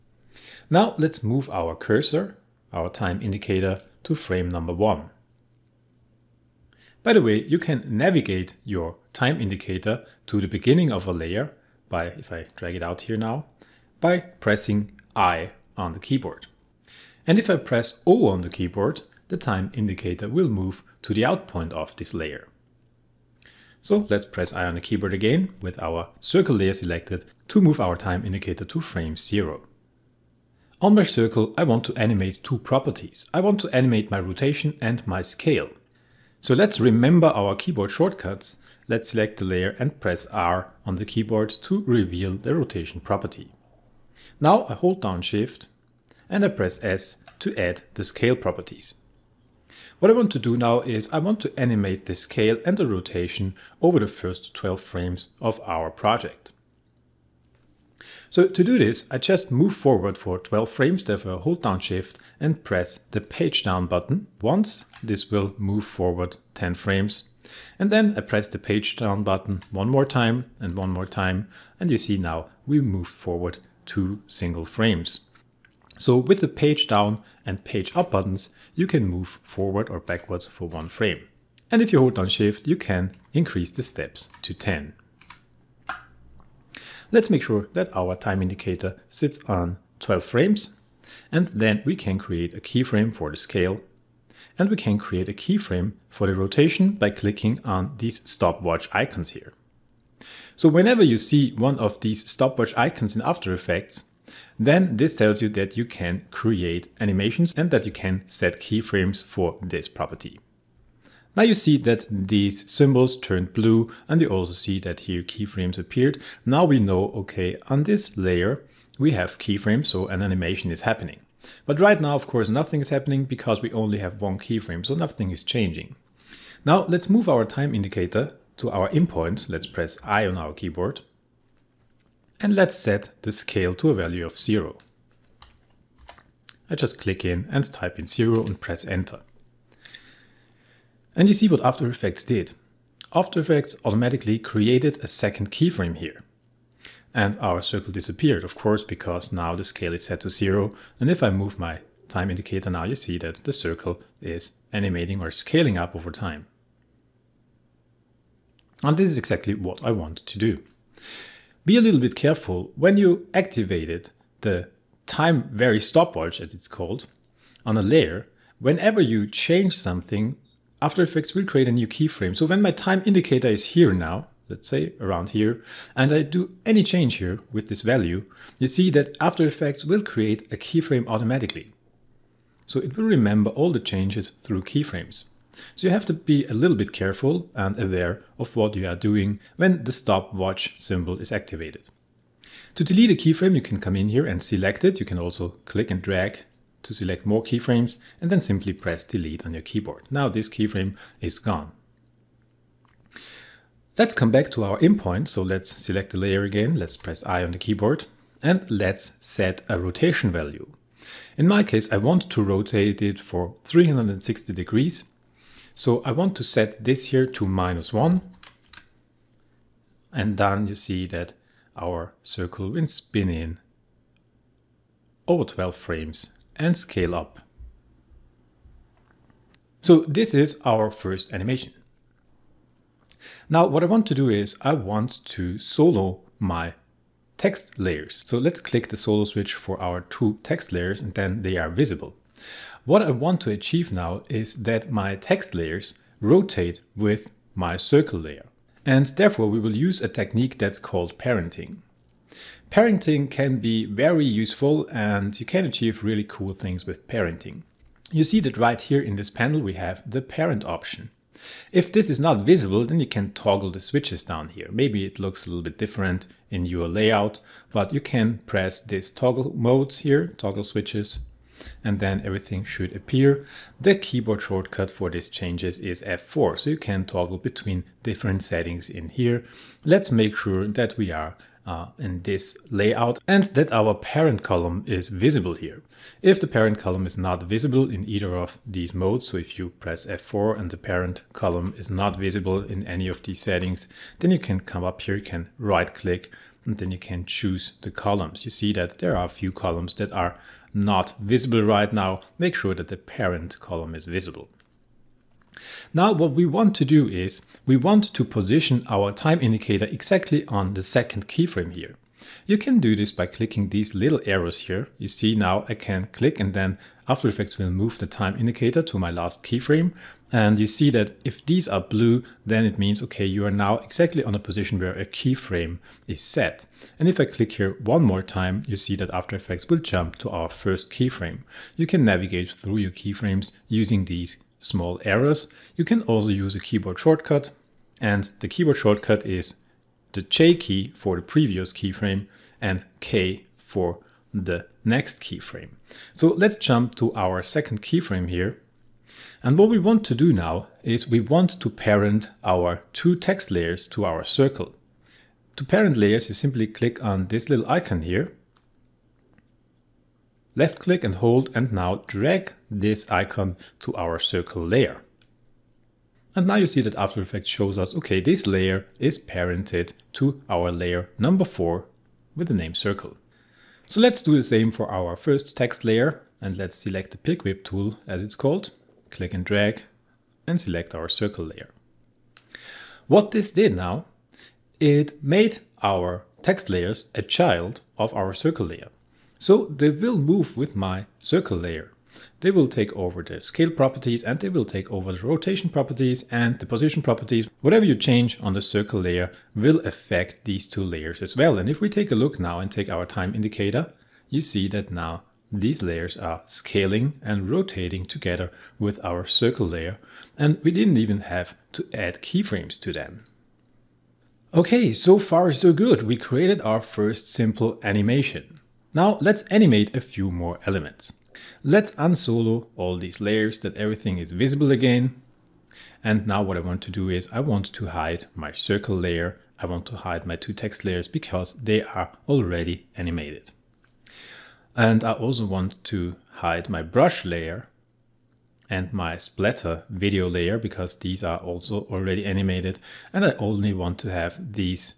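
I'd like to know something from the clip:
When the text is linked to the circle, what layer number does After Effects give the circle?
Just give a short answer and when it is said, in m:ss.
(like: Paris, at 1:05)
4, at 6:11.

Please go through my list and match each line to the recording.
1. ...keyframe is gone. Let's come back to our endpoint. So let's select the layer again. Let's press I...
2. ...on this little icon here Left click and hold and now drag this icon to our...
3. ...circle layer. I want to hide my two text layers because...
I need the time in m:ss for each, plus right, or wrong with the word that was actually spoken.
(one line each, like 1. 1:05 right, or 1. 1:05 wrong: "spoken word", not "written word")
1. 3:20 right
2. 5:57 right
3. 7:08 right.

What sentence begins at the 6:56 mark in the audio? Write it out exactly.
We created our first simple animation.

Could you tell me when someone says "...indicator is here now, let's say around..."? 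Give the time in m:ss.
2:53.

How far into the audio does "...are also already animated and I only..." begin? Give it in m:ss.
7:21.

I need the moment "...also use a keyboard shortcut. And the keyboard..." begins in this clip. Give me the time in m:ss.
5:36.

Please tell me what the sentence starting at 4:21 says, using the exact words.
If this is not visible, then you can toggle the switches down here.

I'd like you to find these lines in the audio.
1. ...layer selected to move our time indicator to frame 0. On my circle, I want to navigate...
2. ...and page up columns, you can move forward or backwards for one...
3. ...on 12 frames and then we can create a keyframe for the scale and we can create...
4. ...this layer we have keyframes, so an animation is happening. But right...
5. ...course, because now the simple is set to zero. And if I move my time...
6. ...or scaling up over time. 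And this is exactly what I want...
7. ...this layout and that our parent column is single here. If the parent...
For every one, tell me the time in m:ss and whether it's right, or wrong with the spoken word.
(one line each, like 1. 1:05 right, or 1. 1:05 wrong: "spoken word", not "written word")
1. 0:26 wrong: "animate", not "navigate"
2. 1:17 wrong: "buttons", not "columns"
3. 1:29 right
4. 1:57 right
5. 2:28 wrong: "scale", not "simple"
6. 2:35 right
7. 4:42 wrong: "visible", not "single".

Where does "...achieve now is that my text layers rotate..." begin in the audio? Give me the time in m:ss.
4:03.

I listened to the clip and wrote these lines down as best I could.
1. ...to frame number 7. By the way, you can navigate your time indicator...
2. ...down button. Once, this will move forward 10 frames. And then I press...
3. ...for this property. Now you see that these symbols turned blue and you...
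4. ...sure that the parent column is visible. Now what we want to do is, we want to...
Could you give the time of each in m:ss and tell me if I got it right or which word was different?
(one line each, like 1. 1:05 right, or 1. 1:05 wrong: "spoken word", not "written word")
1. 0:04 wrong: "1", not "7"
2. 1:03 right
3. 1:49 right
4. 5:02 right.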